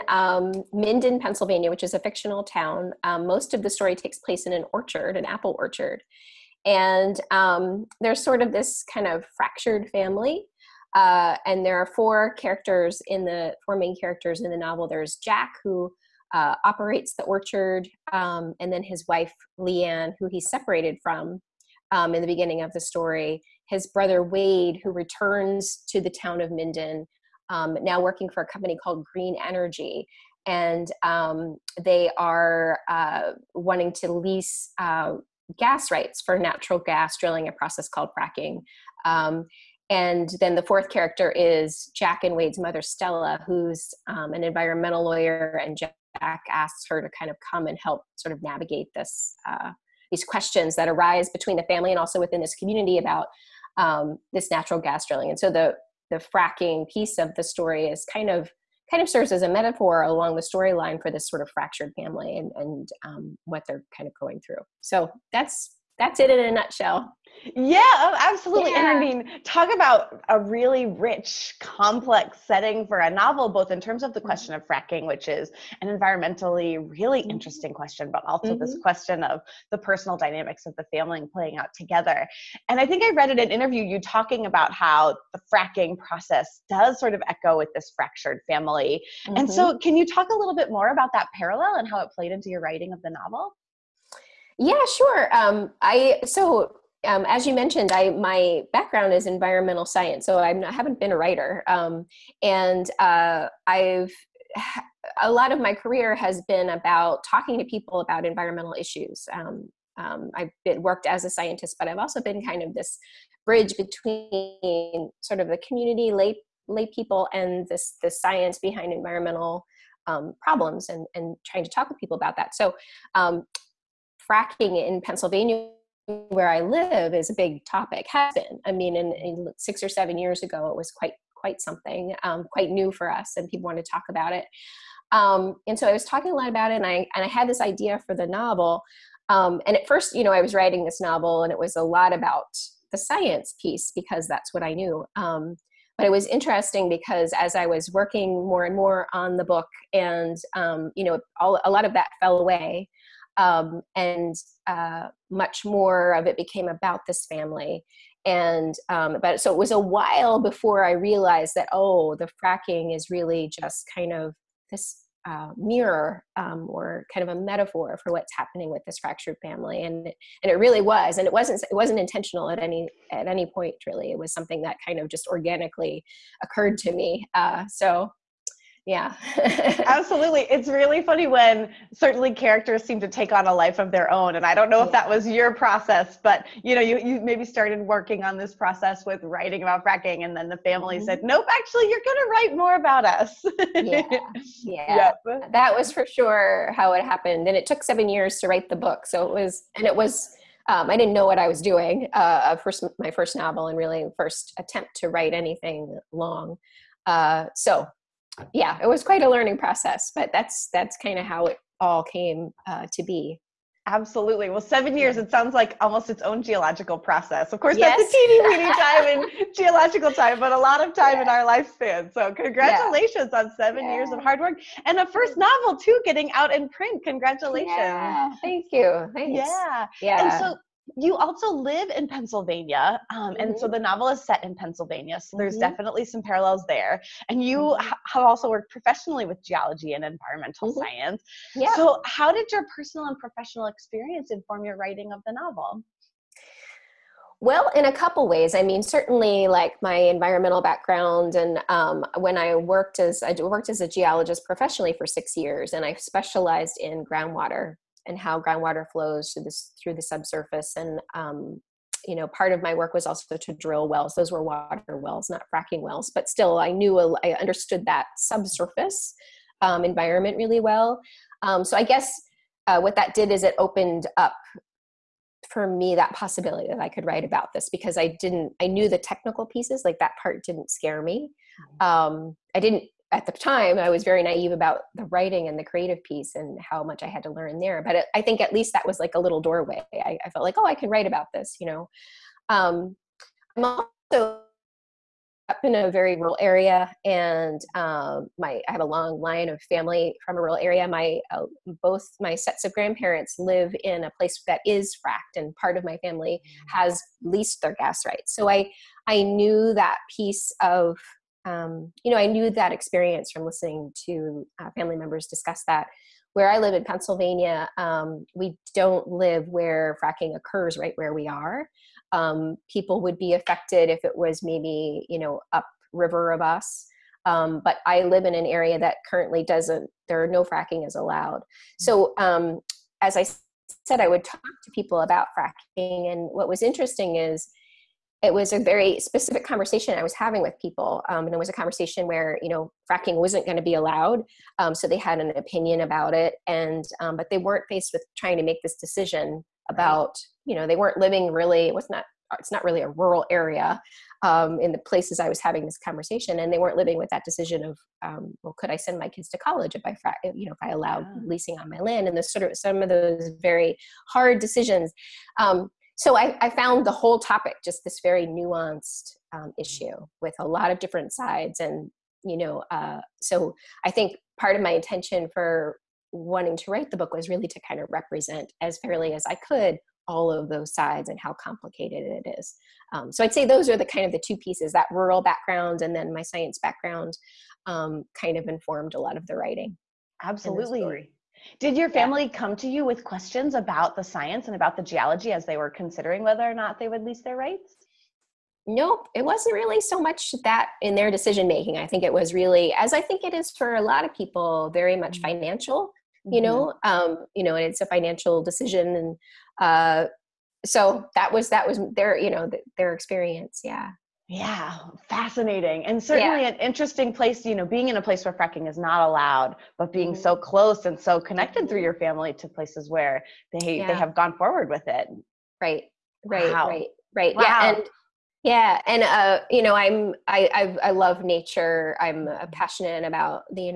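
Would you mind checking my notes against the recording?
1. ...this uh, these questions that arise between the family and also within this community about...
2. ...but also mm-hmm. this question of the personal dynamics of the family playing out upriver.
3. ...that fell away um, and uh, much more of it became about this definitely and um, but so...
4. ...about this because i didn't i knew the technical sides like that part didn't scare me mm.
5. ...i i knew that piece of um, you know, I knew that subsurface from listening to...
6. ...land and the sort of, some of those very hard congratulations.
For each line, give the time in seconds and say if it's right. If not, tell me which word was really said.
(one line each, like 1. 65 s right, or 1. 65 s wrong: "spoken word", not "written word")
1. 48 s right
2. 78 s wrong: "together", not "upriver"
3. 151 s wrong: "family", not "definitely"
4. 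277 s wrong: "pieces", not "sides"
5. 308 s wrong: "experience", not "subsurface"
6. 361 s wrong: "decisions", not "congratulations".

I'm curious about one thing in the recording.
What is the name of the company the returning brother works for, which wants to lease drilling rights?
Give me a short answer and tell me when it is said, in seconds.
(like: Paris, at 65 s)
Green Energy, at 29 s.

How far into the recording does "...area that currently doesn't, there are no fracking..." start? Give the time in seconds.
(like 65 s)
328 s.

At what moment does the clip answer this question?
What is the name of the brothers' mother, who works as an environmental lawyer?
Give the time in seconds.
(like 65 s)
42 s.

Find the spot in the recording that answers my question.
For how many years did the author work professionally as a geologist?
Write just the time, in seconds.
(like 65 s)
255 s.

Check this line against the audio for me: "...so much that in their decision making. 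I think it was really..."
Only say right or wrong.
right.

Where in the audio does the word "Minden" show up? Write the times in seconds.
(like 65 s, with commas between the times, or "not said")
0 s, 26 s.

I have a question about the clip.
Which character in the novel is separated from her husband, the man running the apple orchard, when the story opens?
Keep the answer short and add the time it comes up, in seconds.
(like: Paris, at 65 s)
Leanne, at 19 s.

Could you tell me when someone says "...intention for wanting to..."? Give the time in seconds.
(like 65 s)
374 s.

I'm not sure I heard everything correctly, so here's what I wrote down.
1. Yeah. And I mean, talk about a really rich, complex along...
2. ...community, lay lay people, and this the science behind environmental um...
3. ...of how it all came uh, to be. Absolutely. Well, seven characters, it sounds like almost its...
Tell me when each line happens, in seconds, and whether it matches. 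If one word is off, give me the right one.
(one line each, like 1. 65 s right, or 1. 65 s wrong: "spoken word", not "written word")
1. 68 s wrong: "setting", not "along"
2. 115 s right
3. 211 s wrong: "years", not "characters".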